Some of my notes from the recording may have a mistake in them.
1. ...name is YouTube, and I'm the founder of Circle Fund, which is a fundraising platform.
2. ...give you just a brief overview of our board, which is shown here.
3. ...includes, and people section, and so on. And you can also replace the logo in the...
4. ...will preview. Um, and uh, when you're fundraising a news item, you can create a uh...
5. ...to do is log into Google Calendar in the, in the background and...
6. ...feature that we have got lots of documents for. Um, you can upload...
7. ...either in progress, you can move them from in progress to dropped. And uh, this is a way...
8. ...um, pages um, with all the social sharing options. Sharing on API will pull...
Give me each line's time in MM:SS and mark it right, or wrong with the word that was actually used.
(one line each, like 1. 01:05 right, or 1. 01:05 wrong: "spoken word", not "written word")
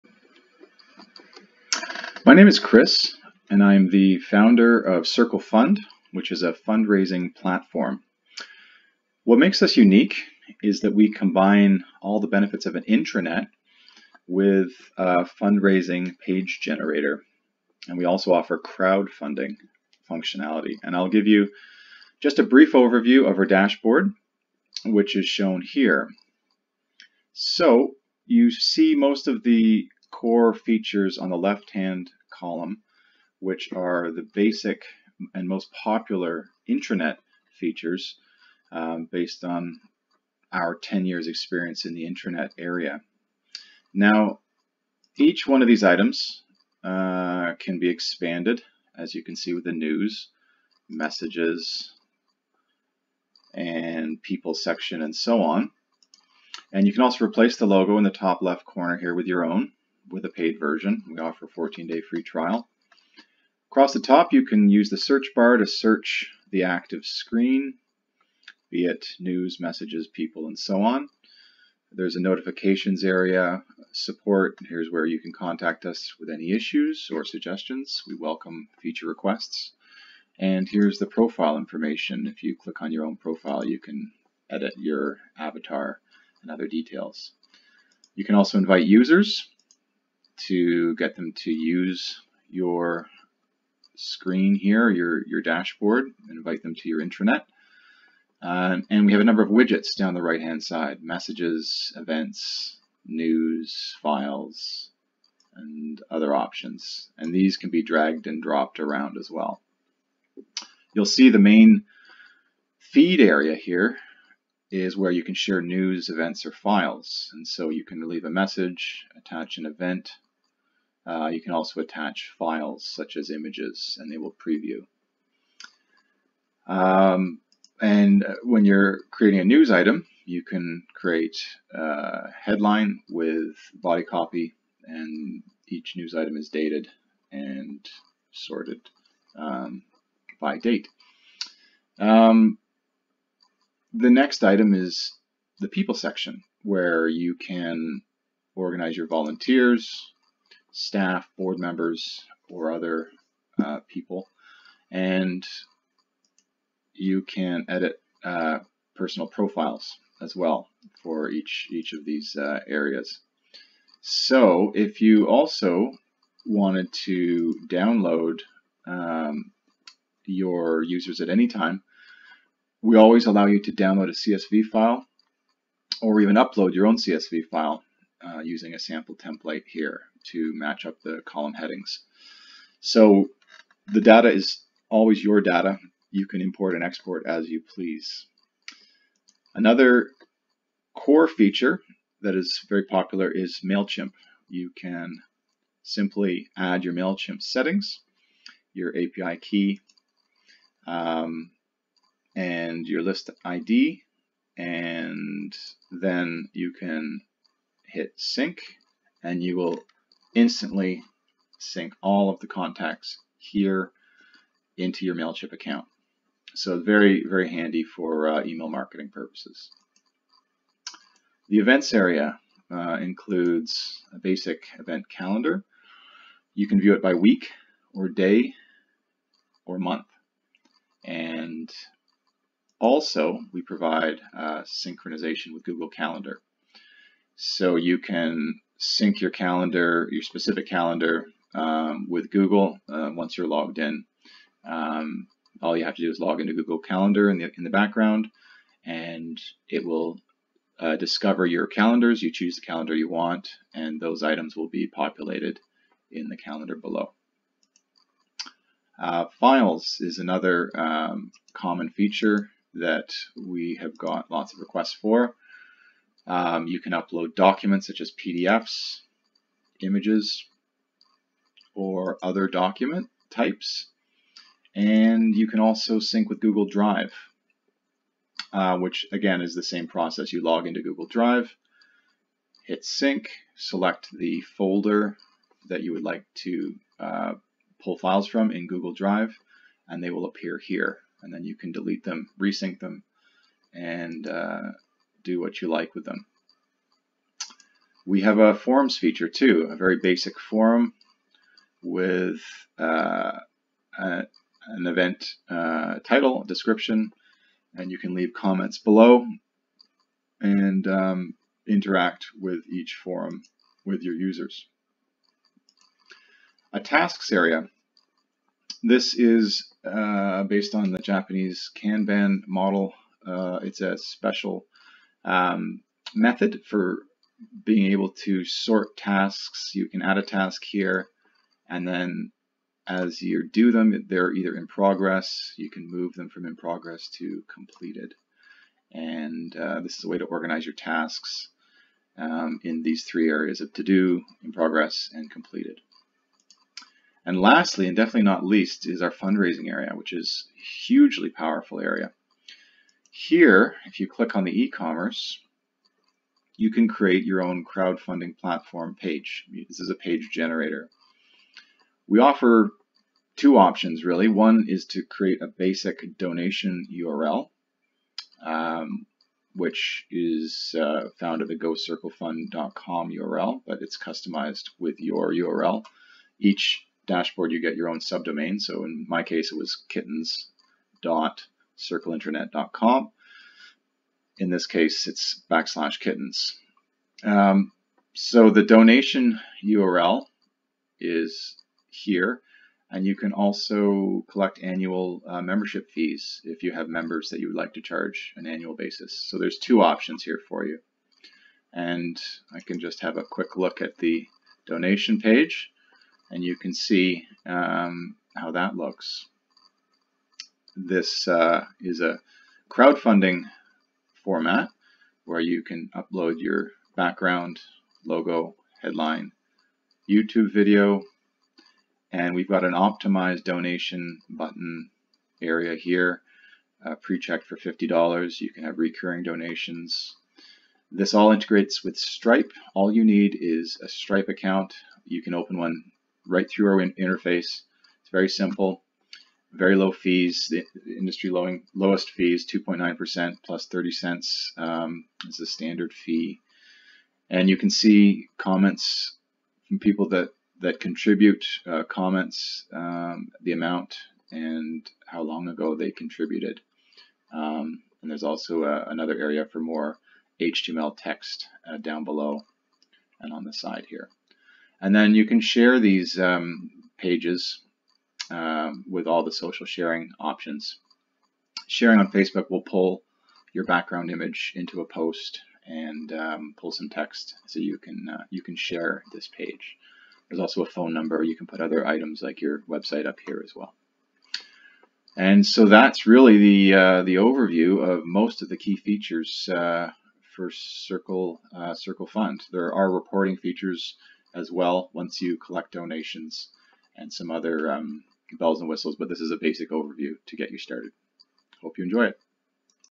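1. 00:02 wrong: "Chris", not "YouTube"
2. 00:21 wrong: "dashboard", not "board"
3. 00:50 wrong: "messages", not "includes"
4. 02:04 wrong: "creating", not "fundraising"
5. 04:05 right
6. 04:21 wrong: "requests", not "documents"
7. 05:34 wrong: "completed", not "dropped"
8. 07:46 wrong: "Facebook", not "API".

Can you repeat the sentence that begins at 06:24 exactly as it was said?
In this case, it's backslash kittens.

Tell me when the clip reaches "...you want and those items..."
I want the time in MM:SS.
04:12.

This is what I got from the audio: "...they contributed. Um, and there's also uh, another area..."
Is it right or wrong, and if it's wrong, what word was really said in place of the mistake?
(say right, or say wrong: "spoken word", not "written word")
right.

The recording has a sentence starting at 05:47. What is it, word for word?
And lastly, and definitely not least, is our fundraising area, which is hugely powerful area.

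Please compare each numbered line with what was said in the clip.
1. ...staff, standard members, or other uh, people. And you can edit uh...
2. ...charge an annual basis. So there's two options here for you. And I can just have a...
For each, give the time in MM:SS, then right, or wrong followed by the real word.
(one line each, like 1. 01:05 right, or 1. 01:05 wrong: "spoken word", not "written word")
1. 02:30 wrong: "board", not "standard"
2. 06:37 right.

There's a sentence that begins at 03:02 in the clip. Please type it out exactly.
So the data is always your data.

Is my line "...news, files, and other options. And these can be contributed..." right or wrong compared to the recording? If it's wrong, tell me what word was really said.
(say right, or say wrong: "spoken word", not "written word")
wrong: "dragged", not "contributed".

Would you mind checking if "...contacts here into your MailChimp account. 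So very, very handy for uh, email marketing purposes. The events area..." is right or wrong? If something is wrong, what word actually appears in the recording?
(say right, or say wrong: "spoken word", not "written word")
right.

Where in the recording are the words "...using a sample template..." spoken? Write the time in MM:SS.
02:58.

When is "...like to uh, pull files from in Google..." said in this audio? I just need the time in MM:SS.
04:46.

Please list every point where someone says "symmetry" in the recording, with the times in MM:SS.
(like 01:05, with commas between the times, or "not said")
not said.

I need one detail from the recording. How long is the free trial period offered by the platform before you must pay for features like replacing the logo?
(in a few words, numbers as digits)
14 days.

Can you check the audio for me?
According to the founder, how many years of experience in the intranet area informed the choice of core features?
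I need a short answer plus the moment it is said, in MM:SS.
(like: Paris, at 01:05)
10 years, at 00:40.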